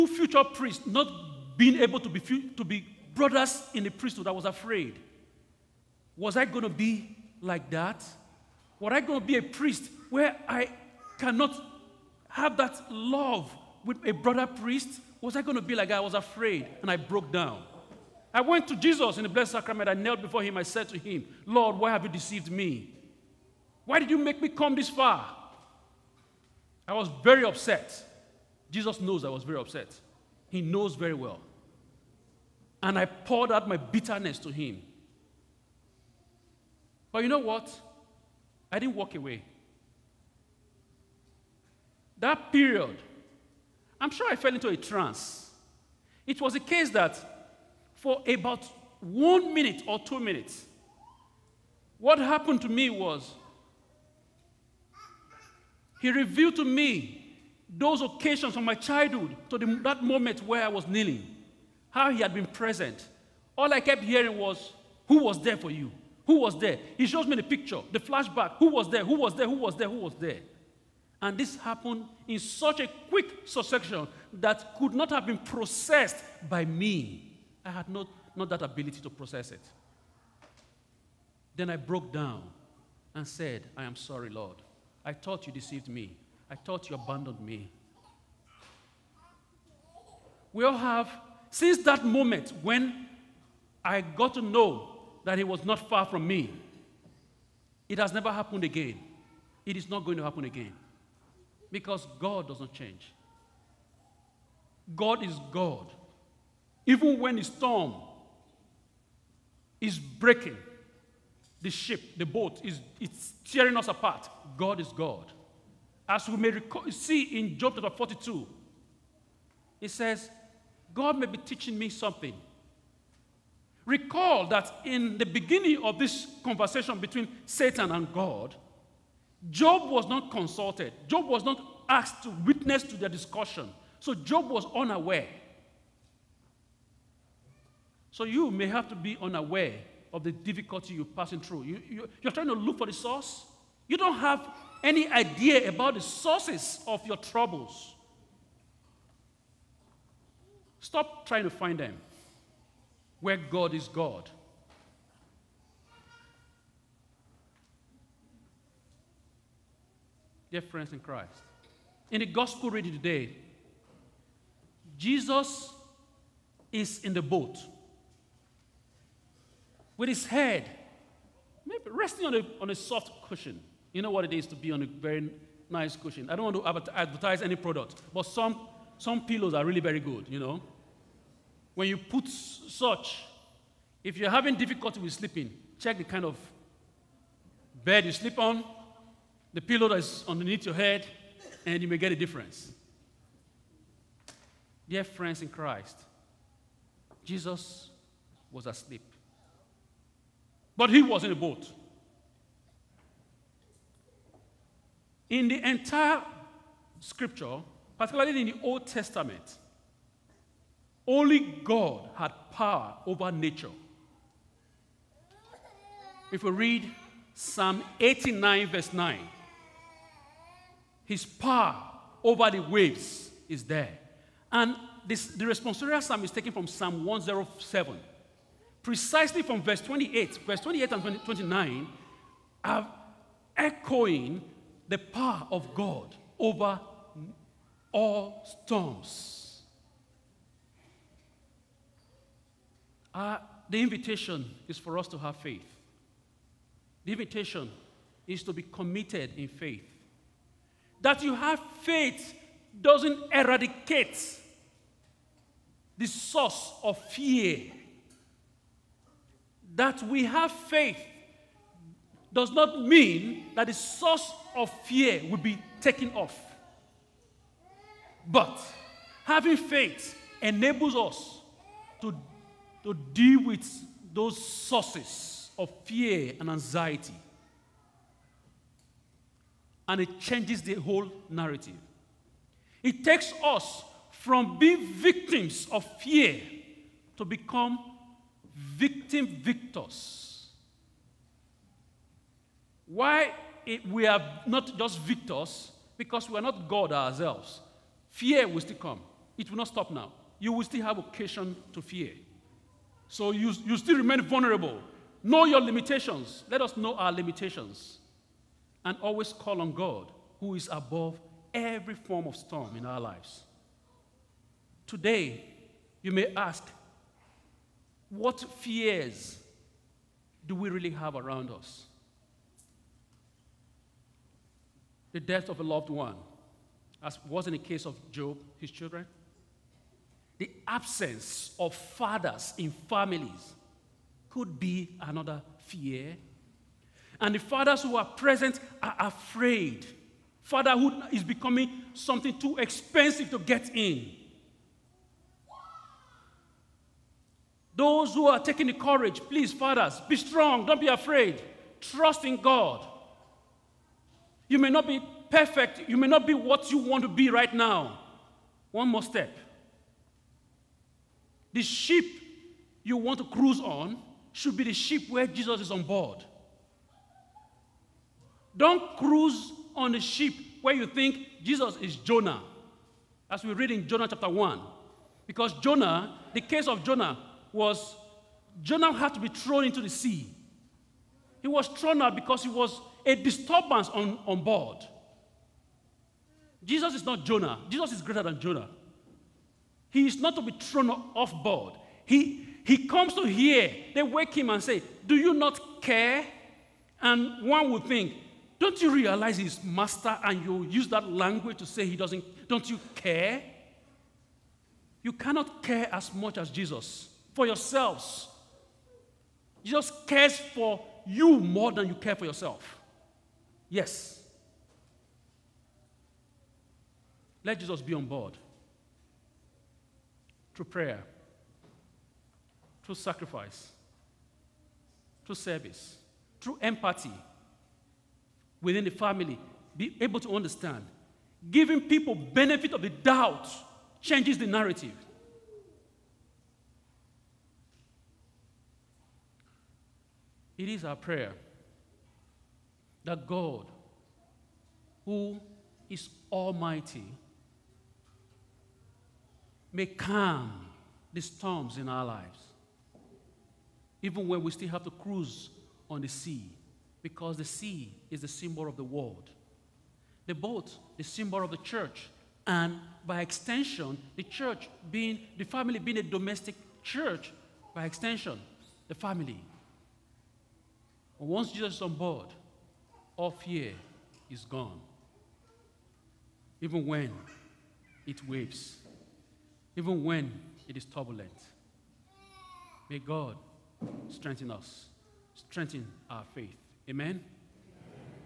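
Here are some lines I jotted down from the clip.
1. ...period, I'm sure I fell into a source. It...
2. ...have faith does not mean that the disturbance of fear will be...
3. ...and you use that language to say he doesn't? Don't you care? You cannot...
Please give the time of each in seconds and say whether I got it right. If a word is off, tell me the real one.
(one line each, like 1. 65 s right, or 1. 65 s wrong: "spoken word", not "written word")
1. 42 s wrong: "trance", not "source"
2. 260 s wrong: "source", not "disturbance"
3. 400 s right.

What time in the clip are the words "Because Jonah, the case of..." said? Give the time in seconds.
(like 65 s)
375 s.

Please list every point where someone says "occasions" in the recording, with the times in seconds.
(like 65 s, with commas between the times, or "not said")
58 s, 300 s.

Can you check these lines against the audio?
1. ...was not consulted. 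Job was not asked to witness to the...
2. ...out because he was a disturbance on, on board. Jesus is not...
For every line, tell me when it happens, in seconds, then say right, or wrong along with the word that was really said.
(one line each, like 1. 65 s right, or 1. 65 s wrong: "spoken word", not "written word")
1. 129 s right
2. 382 s right.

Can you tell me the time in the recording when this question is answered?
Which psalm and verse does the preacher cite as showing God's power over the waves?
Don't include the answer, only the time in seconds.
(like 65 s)
217 s.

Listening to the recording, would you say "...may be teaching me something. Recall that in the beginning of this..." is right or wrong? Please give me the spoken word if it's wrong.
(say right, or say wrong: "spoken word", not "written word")
right.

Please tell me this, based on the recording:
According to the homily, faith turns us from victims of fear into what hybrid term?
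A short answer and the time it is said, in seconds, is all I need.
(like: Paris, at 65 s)
Victim victors, at 288 s.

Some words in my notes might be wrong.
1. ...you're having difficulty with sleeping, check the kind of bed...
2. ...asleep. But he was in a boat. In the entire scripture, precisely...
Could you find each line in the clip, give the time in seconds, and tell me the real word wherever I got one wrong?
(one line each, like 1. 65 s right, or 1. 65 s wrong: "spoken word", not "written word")
1. 184 s right
2. 198 s wrong: "particularly", not "precisely".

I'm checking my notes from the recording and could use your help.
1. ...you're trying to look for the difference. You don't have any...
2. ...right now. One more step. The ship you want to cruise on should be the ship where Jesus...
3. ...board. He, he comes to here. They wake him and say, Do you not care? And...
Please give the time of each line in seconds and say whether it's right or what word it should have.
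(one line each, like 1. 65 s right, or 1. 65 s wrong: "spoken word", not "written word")
1. 142 s wrong: "source", not "difference"
2. 357 s right
3. 391 s right.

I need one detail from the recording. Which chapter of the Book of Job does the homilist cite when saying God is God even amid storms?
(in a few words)
42.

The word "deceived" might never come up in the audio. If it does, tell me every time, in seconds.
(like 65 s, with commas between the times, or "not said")
22 s, 85 s.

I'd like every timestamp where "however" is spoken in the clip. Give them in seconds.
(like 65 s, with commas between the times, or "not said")
not said.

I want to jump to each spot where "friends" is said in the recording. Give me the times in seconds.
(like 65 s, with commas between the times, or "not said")
160 s, 195 s.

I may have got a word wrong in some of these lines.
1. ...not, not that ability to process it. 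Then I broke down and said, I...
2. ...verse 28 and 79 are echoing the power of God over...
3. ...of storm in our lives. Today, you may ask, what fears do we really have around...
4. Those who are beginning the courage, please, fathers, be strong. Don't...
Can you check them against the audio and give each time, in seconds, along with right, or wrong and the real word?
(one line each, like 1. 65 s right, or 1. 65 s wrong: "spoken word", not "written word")
1. 77 s right
2. 230 s wrong: "29", not "79"
3. 312 s right
4. 347 s wrong: "taking", not "beginning".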